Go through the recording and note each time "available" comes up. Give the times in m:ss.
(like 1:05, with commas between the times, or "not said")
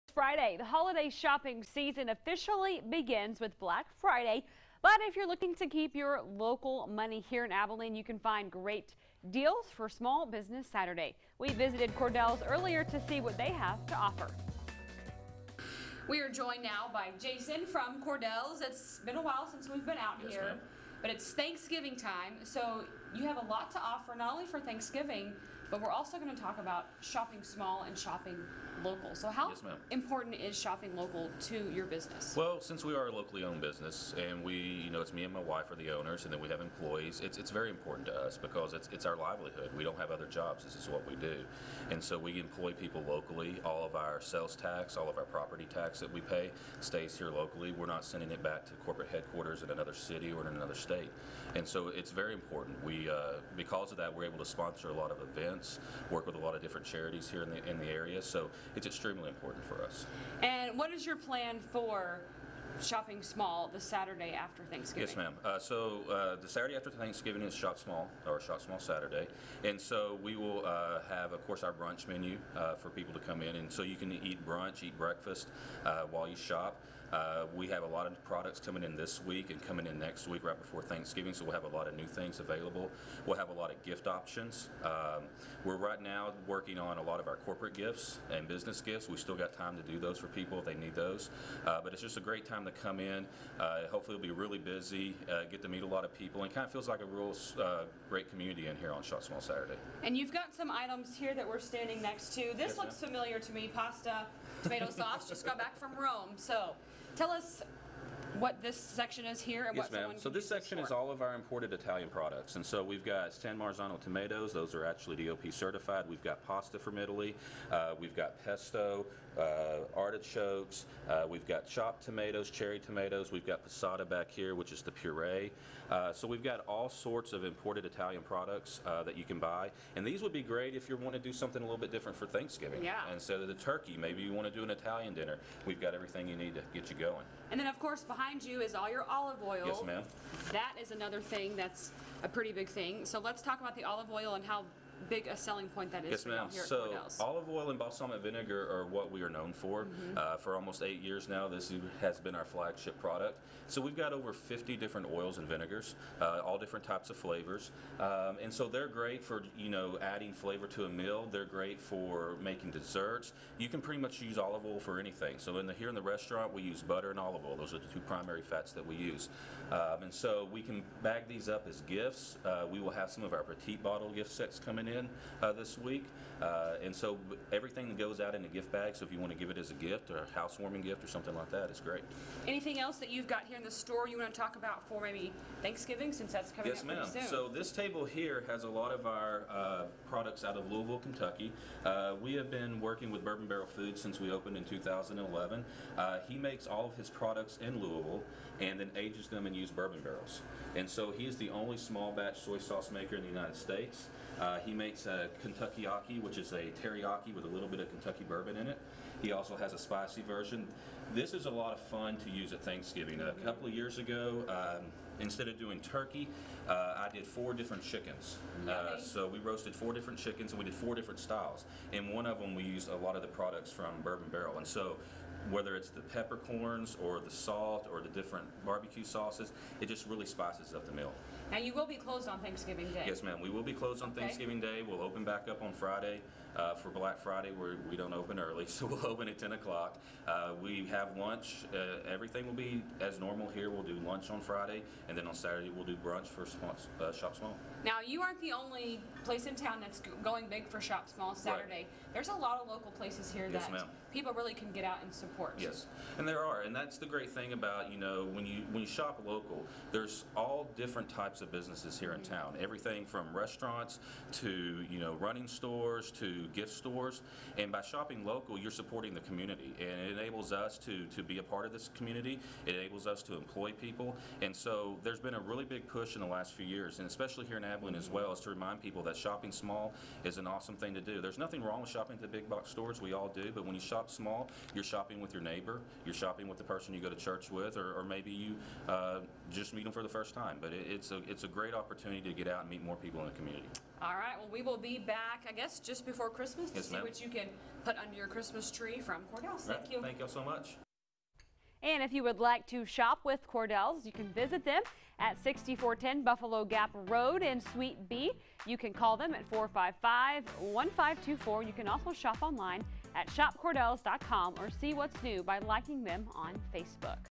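1:22.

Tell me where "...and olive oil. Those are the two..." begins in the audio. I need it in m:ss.
2:47.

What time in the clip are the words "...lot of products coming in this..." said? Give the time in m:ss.
1:17.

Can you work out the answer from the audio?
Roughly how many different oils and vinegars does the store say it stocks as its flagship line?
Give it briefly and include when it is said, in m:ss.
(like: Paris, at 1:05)
over 50, at 2:34.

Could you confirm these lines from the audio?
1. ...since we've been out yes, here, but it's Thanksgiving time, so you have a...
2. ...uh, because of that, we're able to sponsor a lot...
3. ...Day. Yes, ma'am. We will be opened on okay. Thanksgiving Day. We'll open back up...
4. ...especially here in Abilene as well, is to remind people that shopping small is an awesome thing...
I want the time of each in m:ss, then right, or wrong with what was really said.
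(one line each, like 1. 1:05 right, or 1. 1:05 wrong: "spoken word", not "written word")
1. 0:19 right
2. 0:53 right
3. 3:52 wrong: "closed", not "opened"
4. 4:37 right.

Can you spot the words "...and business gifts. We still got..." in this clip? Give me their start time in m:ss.
1:28.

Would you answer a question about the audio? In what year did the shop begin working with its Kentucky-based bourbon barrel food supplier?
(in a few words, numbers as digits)
2011.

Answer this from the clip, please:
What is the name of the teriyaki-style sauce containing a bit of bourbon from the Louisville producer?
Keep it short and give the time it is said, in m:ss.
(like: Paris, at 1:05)
Kentuckyaki, at 3:25.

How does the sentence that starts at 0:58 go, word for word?
So it's extremely important for us.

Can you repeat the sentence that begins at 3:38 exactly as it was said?
Uh, so we roasted four different chickens and we did four different styles.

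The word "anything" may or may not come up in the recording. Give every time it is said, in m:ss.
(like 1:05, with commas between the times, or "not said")
2:44, 3:02.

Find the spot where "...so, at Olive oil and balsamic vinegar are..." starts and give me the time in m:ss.
2:26.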